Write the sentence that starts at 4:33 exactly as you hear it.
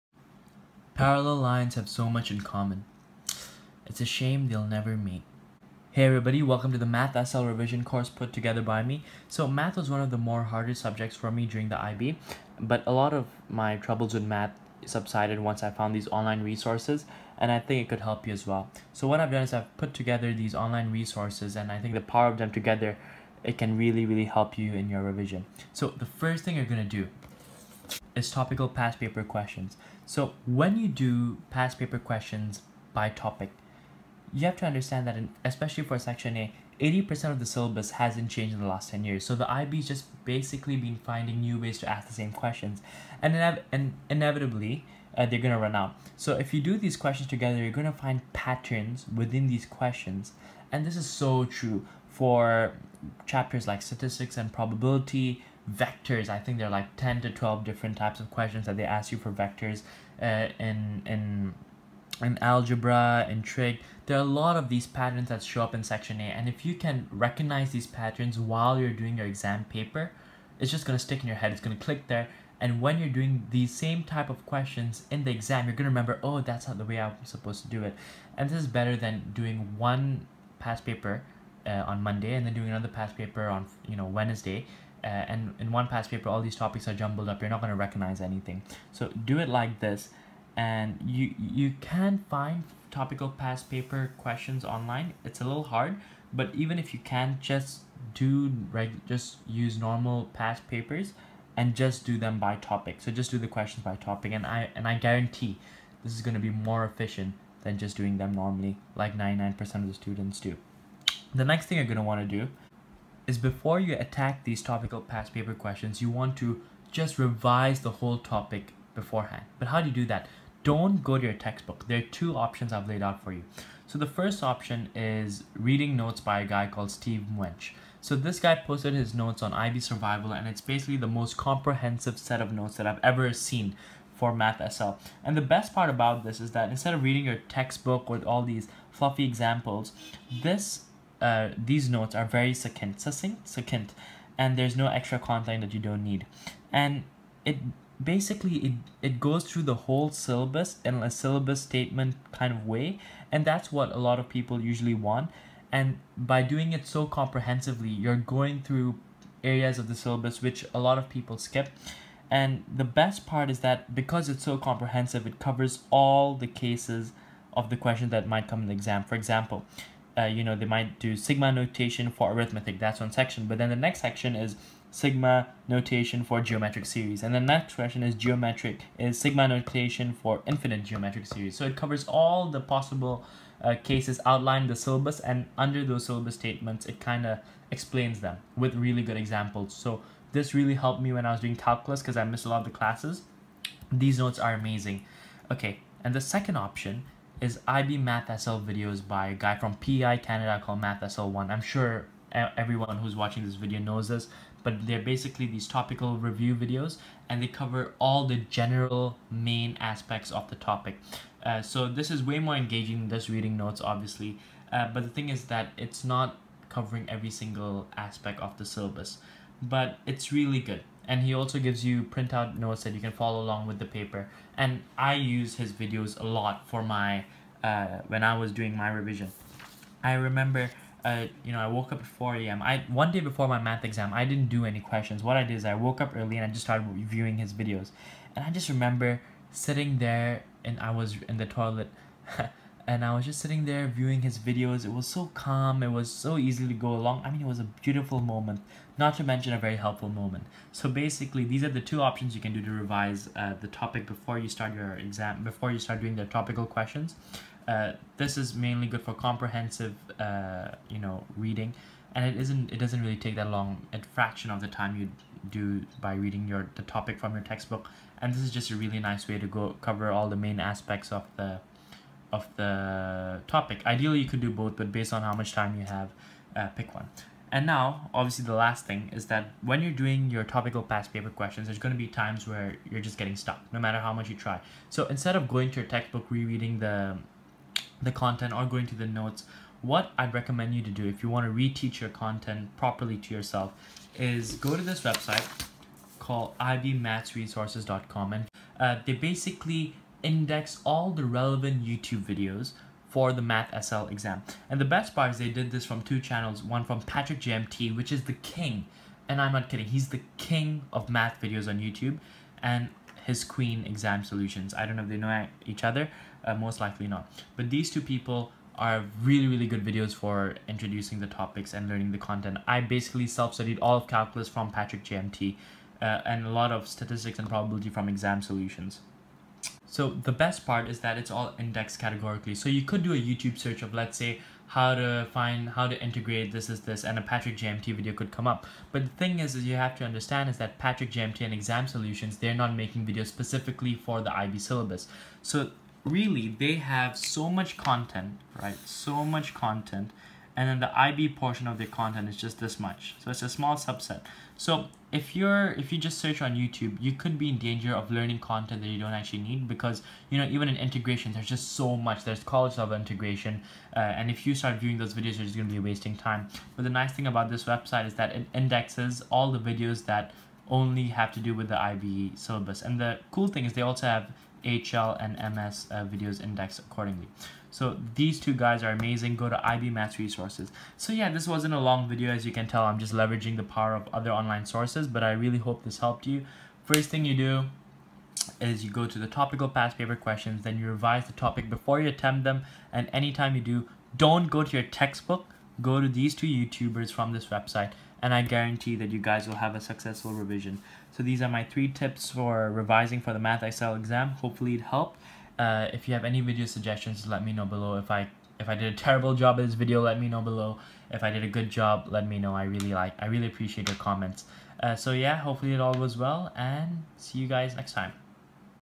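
Ideally, you could do both, but based on how much time you have, uh, pick one.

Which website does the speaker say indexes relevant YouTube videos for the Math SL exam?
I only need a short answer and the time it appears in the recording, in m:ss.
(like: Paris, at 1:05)
ibmathsresources.com, at 4:56.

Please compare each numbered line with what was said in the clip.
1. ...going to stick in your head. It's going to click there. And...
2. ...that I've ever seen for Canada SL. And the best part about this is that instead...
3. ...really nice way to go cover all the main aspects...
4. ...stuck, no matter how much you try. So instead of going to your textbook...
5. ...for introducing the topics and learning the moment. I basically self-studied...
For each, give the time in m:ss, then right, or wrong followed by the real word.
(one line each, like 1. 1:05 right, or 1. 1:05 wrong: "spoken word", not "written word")
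1. 1:10 right
2. 2:12 wrong: "Math", not "Canada"
3. 4:28 right
4. 4:43 right
5. 5:20 wrong: "content", not "moment".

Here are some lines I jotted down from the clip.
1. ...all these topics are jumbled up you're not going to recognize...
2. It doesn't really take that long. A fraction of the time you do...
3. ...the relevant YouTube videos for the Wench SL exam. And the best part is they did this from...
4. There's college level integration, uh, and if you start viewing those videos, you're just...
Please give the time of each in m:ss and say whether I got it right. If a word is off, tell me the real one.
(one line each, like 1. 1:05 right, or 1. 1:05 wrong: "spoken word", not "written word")
1. 1:26 right
2. 4:22 right
3. 5:01 wrong: "Math", not "Wench"
4. 6:02 right.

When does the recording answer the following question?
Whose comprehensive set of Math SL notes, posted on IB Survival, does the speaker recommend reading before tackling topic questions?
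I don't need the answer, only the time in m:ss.
2:06.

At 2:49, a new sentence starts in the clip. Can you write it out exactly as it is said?
For example, uh, you know, they might do sigma notation for arithmetic.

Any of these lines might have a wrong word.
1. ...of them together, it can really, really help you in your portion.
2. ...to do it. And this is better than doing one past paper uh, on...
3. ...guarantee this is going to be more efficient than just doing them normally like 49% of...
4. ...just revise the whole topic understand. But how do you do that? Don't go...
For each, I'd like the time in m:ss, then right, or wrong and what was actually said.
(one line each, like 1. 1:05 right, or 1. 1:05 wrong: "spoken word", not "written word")
1. 0:22 wrong: "revision", not "portion"
2. 1:17 right
3. 1:44 wrong: "99", not "49"
4. 1:56 wrong: "beforehand", not "understand".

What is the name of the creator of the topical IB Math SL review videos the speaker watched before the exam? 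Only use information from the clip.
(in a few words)
MathSL1.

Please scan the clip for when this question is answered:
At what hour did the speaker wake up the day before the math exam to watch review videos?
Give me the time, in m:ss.
3:52.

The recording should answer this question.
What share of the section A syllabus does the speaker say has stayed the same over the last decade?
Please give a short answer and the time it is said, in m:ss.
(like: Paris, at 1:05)
80%, at 0:36.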